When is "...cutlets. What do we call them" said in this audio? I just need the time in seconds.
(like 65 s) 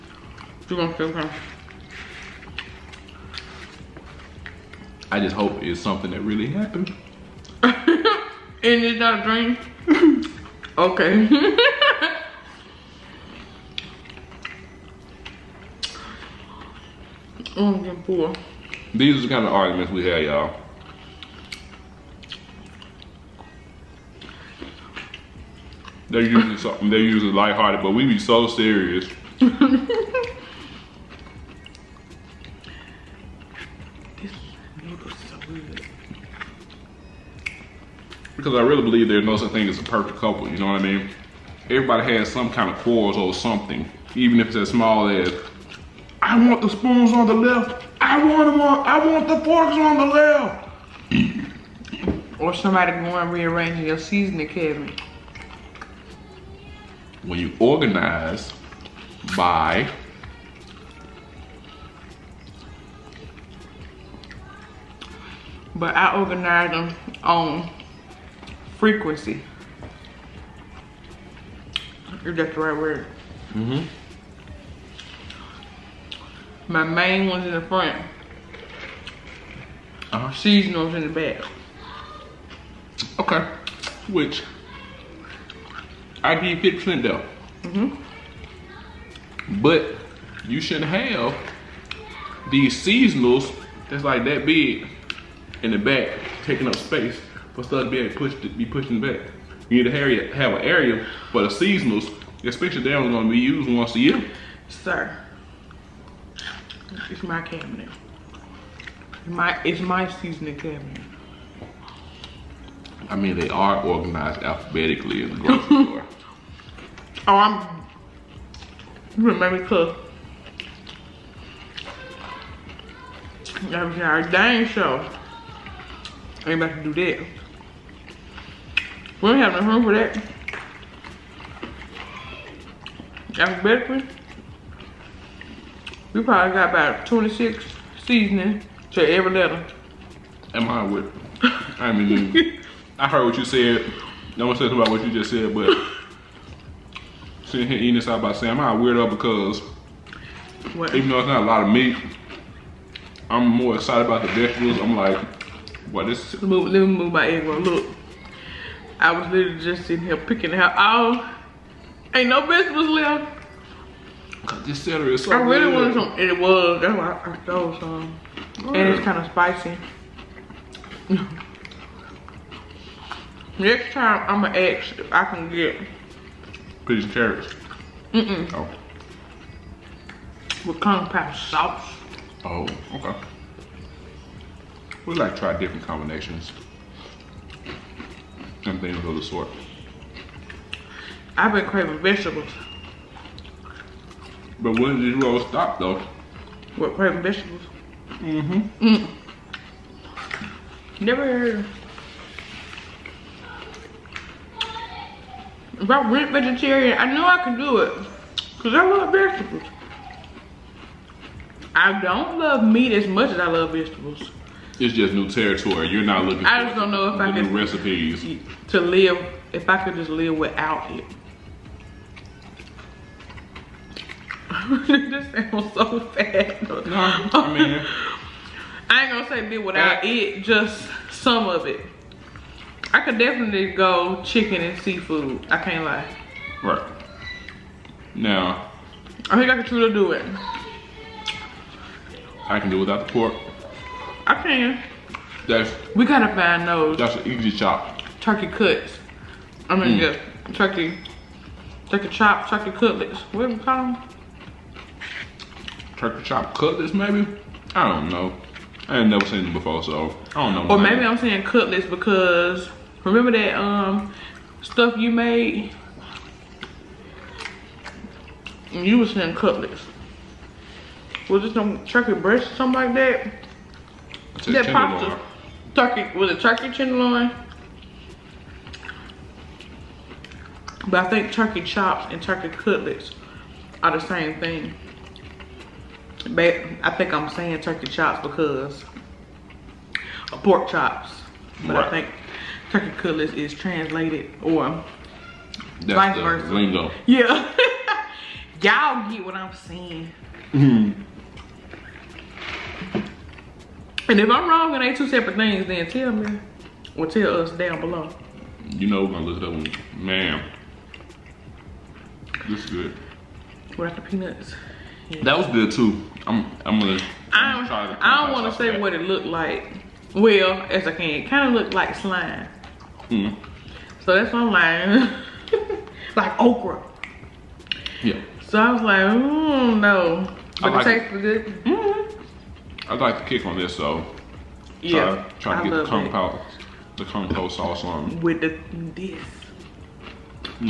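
252 s.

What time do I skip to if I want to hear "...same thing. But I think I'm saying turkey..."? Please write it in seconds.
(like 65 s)
284 s.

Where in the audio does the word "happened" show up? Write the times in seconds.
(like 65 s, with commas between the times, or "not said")
6 s.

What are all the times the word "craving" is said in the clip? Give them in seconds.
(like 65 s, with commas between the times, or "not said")
191 s, 196 s.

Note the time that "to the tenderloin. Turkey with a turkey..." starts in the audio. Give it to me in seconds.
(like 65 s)
274 s.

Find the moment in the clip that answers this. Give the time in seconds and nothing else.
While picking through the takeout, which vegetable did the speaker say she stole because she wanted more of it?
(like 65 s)
164 s.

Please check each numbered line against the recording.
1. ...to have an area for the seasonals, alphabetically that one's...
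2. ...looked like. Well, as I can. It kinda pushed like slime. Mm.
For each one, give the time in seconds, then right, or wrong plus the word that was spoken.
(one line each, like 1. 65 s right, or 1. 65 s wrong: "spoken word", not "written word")
1. 99 s wrong: "especially", not "alphabetically"
2. 319 s wrong: "looked", not "pushed".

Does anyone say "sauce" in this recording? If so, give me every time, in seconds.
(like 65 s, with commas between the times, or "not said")
181 s, 337 s.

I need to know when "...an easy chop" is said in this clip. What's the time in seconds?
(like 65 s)
247 s.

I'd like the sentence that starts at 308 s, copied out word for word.
You know we're gonna look it up one.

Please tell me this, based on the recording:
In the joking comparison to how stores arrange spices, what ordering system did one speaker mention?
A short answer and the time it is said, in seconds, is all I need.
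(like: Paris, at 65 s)
alphabetically, at 114 s.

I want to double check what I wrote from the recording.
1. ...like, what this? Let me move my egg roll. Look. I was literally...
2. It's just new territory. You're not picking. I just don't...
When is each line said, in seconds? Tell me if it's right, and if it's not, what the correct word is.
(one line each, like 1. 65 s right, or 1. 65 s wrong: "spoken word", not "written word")
1. 154 s right
2. 214 s wrong: "looking", not "picking".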